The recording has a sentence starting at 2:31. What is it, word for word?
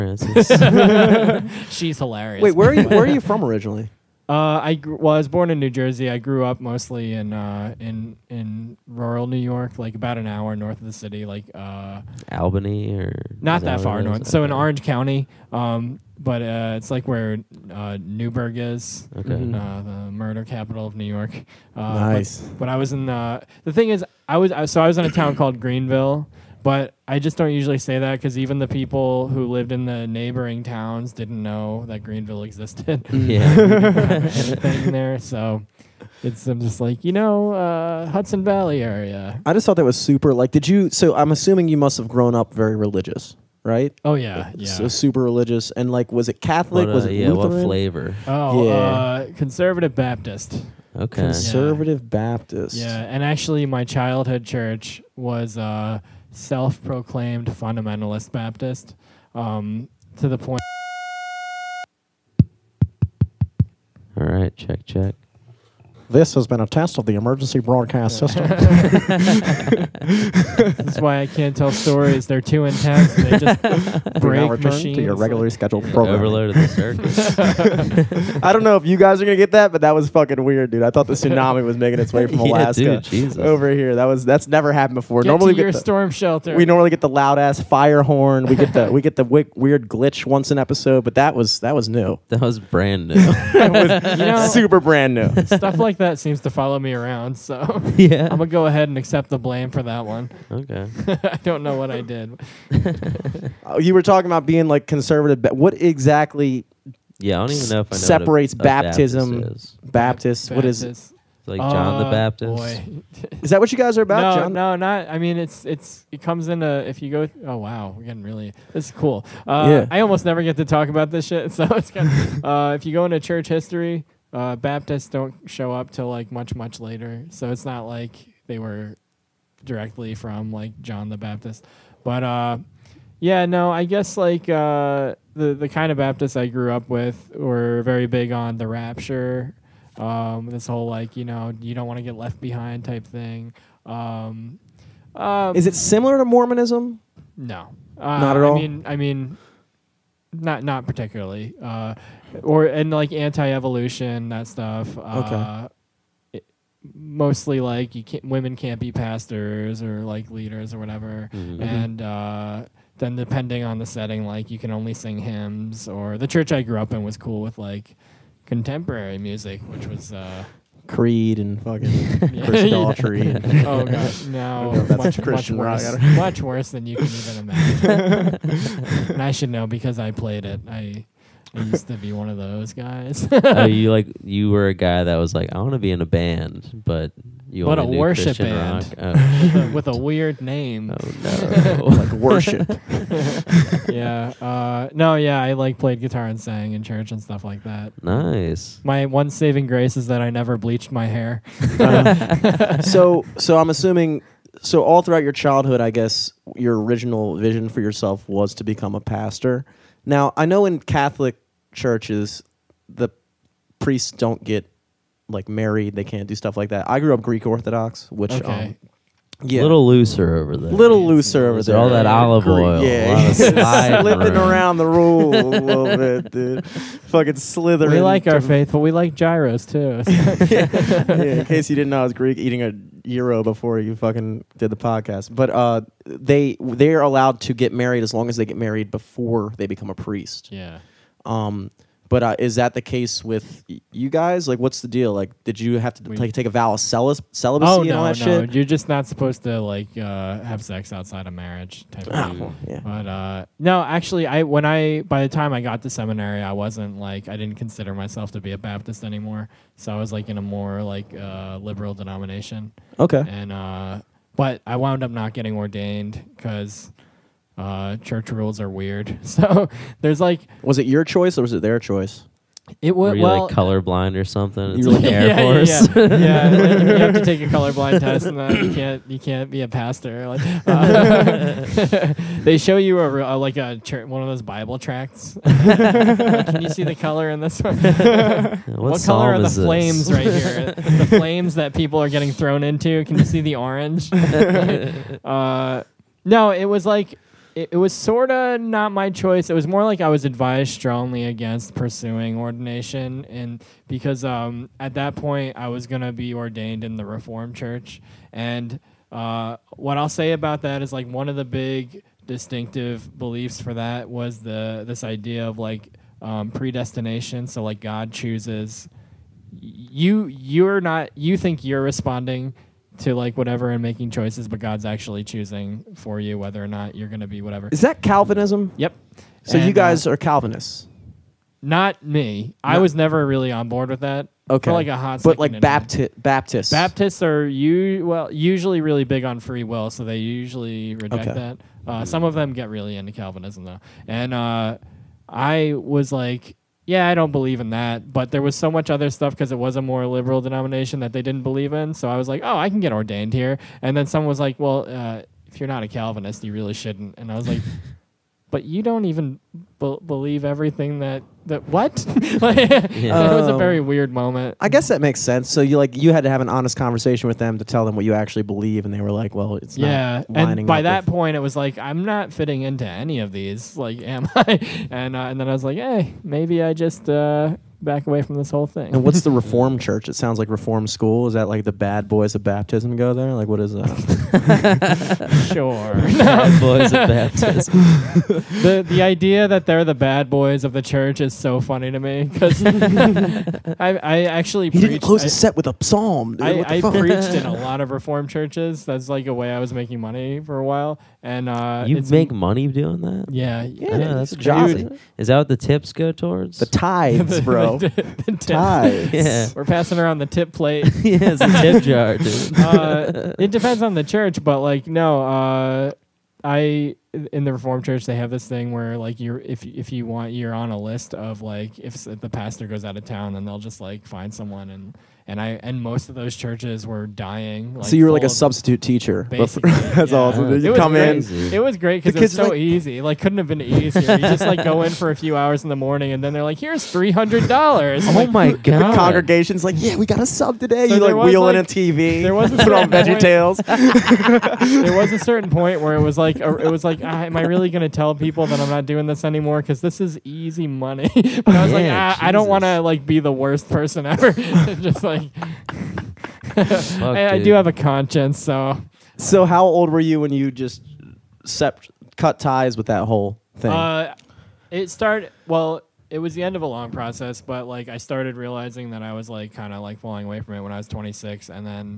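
Uh, or and like anti-evolution that stuff.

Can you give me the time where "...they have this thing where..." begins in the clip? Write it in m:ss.
6:58.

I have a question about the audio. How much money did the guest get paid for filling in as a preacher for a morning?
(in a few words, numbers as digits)
$300.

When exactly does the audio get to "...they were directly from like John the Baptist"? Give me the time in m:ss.
2:08.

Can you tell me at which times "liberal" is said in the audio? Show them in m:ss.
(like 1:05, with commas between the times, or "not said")
4:21, 5:50.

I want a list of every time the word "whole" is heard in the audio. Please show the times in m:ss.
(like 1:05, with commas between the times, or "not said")
2:20, 6:18, 7:43.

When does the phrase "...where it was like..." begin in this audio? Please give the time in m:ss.
7:25.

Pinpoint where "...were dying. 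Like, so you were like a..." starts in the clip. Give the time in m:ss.
7:06.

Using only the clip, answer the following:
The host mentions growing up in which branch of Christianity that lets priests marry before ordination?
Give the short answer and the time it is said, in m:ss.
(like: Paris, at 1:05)
Greek Orthodox, at 3:37.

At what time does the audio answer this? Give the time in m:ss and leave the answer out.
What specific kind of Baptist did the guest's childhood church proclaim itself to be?
0:57.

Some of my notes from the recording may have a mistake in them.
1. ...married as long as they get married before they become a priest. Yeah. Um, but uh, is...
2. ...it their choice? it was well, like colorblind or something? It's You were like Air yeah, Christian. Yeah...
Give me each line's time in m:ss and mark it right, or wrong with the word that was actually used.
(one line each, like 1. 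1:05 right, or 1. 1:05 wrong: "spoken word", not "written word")
1. 3:57 right
2. 4:31 wrong: "Force", not "Christian".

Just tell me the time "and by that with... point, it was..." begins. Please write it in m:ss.
6:10.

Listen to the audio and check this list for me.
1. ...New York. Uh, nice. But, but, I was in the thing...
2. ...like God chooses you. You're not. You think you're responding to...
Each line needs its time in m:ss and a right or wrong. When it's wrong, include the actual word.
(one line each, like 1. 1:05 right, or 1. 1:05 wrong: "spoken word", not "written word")
1. 0:20 right
2. 5:17 right.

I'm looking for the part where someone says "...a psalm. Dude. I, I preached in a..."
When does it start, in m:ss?
6:35.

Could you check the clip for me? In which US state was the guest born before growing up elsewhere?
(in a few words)
New Jersey.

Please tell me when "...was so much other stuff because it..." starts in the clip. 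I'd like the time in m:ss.
5:48.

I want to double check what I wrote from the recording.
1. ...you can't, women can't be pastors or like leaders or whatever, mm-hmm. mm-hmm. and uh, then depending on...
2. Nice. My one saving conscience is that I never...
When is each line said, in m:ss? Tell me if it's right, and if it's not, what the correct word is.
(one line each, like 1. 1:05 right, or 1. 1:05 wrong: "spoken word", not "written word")
1. 2:37 right
2. 3:18 wrong: "grace", not "conscience".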